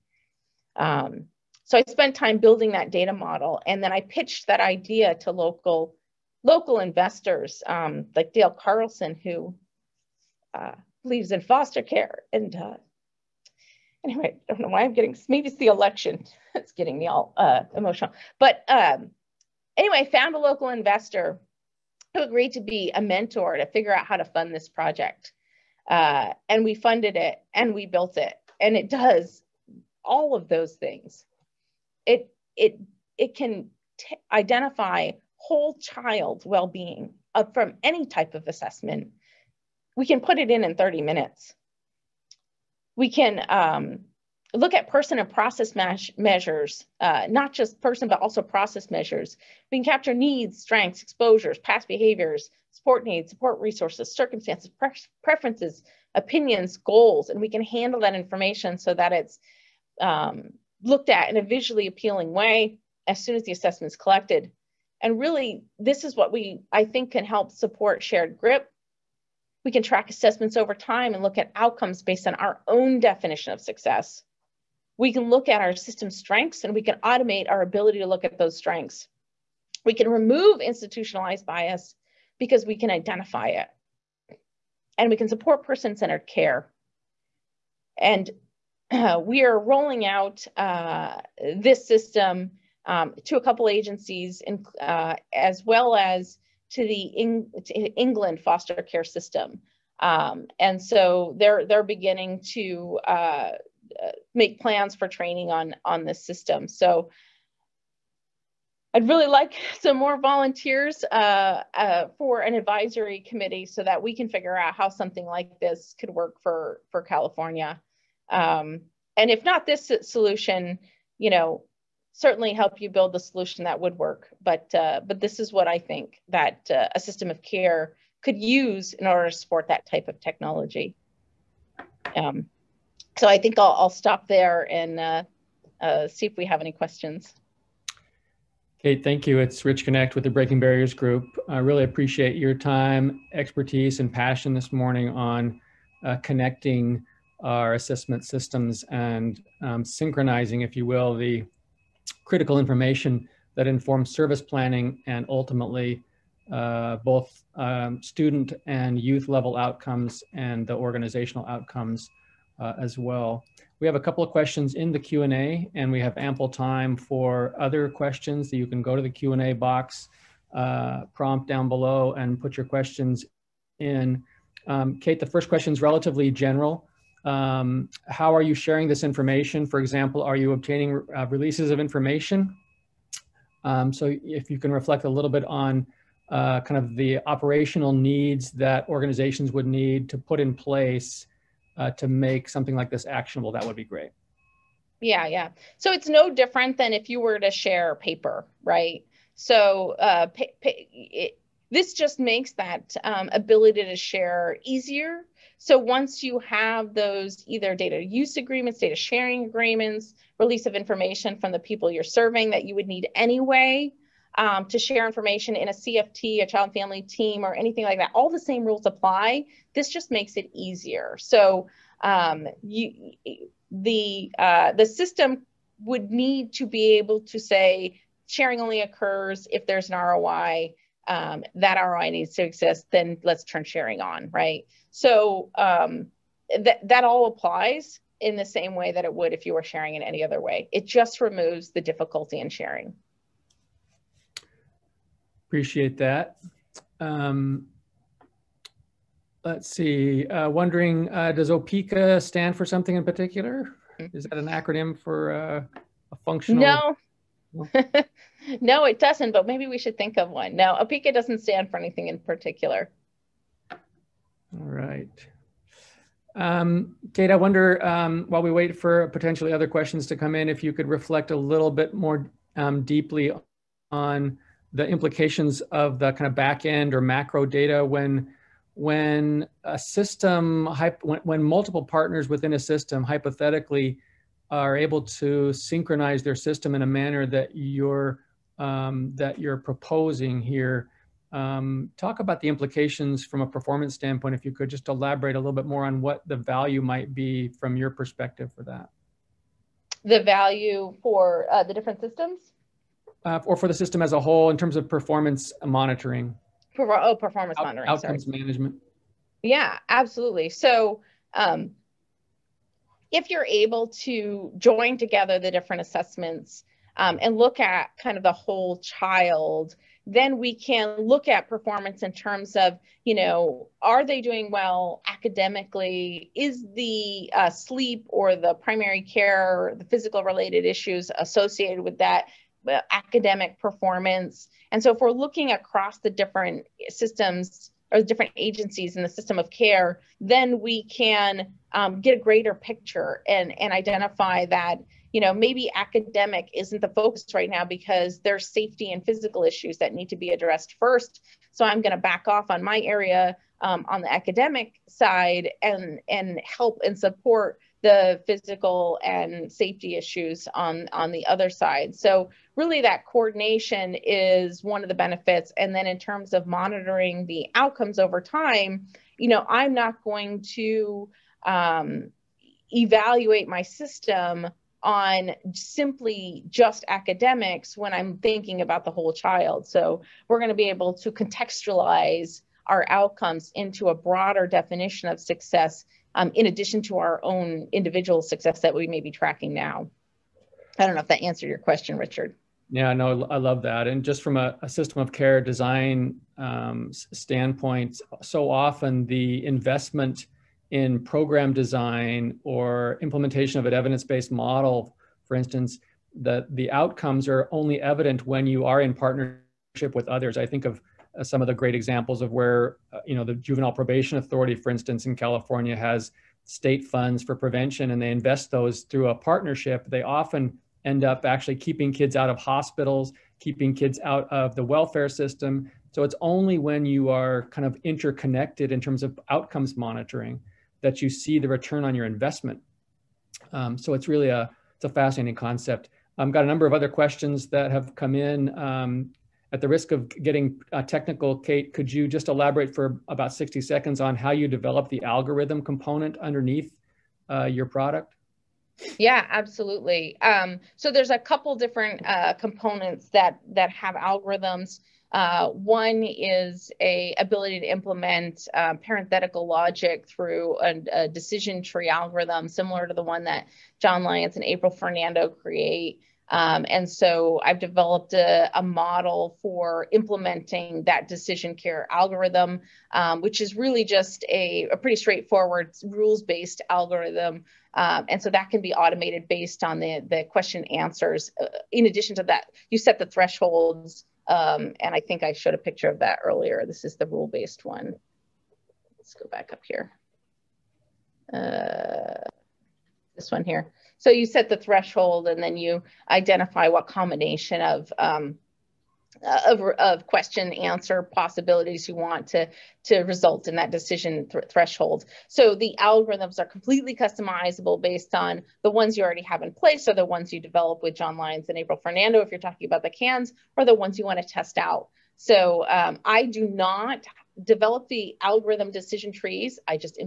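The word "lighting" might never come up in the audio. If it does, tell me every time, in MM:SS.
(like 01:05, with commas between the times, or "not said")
not said.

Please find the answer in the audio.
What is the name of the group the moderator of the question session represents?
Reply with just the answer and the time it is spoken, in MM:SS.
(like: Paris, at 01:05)
Breaking Barriers Group, at 02:20.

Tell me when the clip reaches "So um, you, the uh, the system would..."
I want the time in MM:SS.
03:41.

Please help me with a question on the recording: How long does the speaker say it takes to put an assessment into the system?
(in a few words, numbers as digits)
30 minutes.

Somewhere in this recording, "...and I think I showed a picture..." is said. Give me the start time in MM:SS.
08:04.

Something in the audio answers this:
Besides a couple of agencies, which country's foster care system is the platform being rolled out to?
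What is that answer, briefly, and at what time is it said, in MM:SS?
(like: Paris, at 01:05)
England, at 01:37.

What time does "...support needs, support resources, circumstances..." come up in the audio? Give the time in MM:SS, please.
00:52.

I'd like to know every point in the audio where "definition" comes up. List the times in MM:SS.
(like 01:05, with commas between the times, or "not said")
01:12, 06:24.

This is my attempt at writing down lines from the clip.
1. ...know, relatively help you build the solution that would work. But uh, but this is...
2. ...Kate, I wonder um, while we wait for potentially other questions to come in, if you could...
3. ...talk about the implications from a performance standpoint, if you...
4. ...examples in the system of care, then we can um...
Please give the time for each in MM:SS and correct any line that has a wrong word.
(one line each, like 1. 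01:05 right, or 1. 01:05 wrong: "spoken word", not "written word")
1. 02:01 wrong: "certainly", not "relatively"
2. 04:27 right
3. 04:51 right
4. 05:38 wrong: "agencies", not "examples".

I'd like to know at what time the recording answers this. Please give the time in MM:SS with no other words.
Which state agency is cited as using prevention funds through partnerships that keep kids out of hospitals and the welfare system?
06:53.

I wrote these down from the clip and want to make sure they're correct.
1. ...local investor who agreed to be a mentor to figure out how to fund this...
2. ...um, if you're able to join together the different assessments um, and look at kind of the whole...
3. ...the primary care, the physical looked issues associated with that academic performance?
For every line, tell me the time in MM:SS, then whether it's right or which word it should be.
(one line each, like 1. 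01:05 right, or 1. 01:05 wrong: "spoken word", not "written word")
1. 00:20 right
2. 05:11 right
3. 05:28 wrong: "related", not "looked".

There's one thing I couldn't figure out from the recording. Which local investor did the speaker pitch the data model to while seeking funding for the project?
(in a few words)
Dale Carlson.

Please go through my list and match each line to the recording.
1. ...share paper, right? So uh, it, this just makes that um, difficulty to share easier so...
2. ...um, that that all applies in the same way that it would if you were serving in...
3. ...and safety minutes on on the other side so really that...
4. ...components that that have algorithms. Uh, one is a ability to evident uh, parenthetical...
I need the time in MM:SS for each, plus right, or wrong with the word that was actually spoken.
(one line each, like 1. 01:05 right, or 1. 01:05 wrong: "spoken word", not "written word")
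1. 03:17 wrong: "ability", not "difficulty"
2. 03:55 wrong: "sharing", not "serving"
3. 05:59 wrong: "issues", not "minutes"
4. 07:32 wrong: "implement", not "evident".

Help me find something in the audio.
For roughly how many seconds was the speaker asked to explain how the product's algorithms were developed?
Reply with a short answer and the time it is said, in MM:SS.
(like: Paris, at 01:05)
60, at 07:23.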